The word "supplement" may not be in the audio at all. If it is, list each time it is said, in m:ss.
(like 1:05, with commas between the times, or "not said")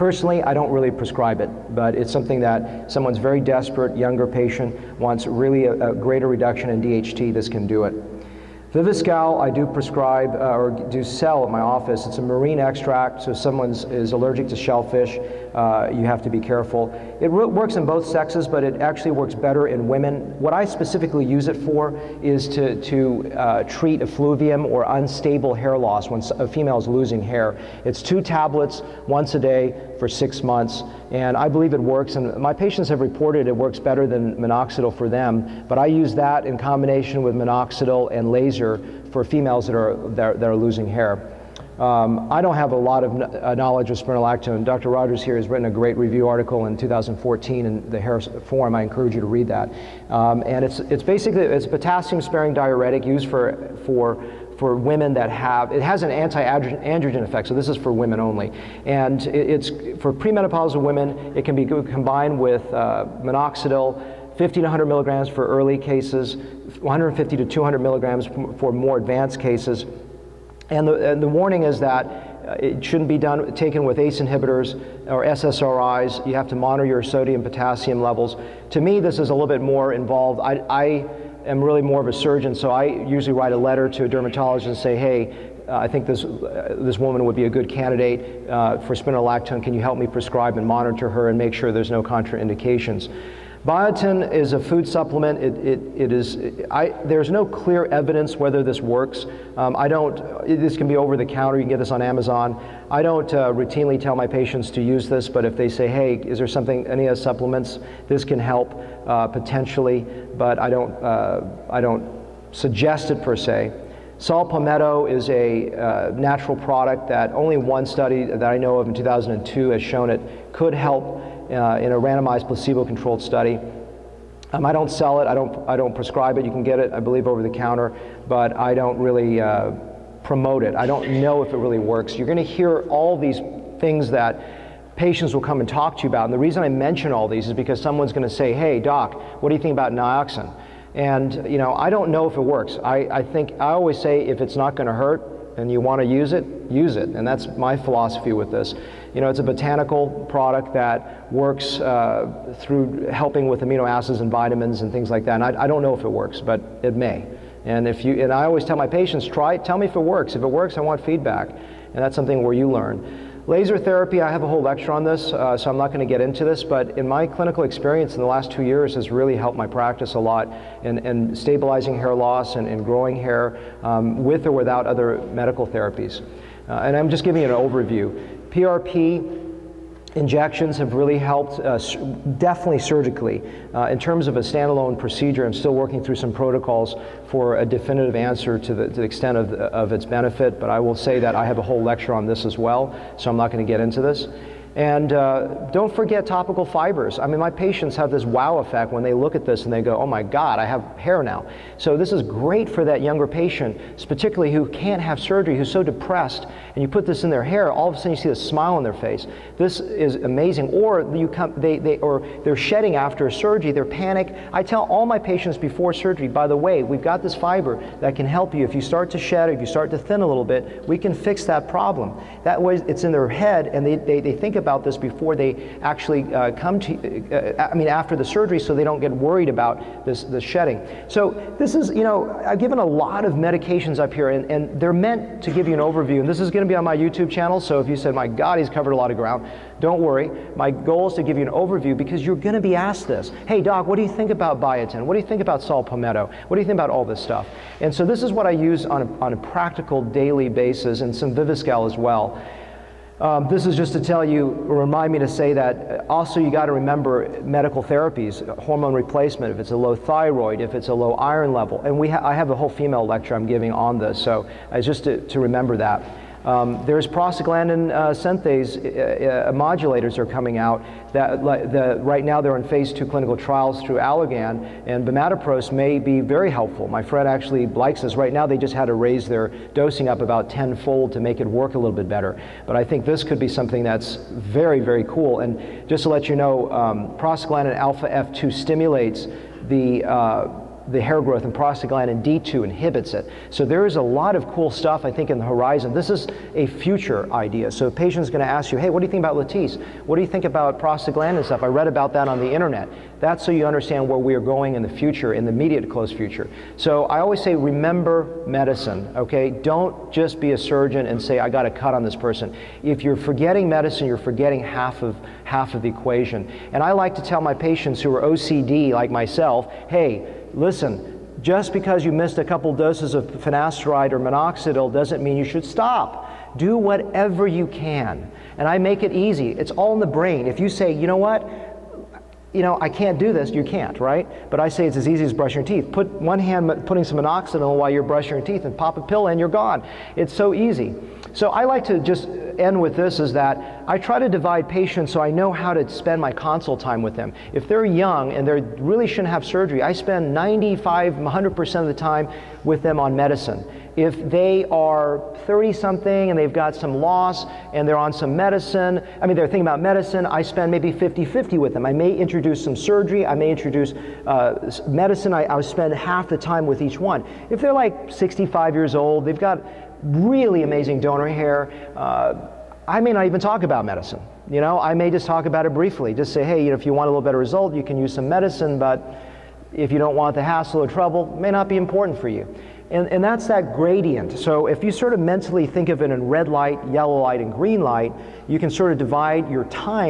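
1:34, 1:47.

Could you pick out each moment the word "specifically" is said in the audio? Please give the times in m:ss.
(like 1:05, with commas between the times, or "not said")
0:20.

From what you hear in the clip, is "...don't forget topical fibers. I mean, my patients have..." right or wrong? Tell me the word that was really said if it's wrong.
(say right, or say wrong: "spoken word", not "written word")
right.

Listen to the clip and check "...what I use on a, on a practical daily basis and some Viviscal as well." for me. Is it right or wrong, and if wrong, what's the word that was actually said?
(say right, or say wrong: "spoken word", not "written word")
right.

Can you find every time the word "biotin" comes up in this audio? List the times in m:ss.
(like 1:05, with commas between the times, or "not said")
1:33, 4:04.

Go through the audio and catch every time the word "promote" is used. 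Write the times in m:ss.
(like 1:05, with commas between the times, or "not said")
2:10.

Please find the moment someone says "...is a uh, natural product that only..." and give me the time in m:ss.
1:55.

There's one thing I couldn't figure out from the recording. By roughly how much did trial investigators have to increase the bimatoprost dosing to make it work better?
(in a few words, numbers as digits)
tenfold.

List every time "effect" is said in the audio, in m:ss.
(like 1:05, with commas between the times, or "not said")
0:57, 3:18.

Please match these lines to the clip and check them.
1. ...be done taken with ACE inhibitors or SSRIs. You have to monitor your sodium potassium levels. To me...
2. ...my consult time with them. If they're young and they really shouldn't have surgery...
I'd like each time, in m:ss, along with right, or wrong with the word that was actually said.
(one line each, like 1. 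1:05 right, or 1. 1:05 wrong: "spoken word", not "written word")
1. 1:13 right
2. 5:46 right.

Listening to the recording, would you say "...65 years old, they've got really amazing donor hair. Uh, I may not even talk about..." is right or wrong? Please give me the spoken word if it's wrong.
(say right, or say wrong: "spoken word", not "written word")
right.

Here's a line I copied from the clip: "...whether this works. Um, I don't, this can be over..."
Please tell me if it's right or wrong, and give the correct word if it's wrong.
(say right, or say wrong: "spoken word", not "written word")
right.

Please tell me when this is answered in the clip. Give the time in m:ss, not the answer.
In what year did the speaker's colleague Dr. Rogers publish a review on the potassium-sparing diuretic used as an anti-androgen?
0:46.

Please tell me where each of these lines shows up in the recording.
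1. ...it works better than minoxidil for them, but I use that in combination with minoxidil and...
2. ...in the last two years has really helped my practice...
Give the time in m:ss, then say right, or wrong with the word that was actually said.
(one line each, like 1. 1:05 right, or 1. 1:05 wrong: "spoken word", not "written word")
1. 0:33 right
2. 2:48 right.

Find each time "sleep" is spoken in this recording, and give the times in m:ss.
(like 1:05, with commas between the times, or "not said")
not said.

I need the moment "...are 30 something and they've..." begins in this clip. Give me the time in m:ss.
5:54.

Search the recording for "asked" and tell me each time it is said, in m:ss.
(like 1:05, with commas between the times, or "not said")
4:02.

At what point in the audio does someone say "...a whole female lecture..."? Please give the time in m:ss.
4:22.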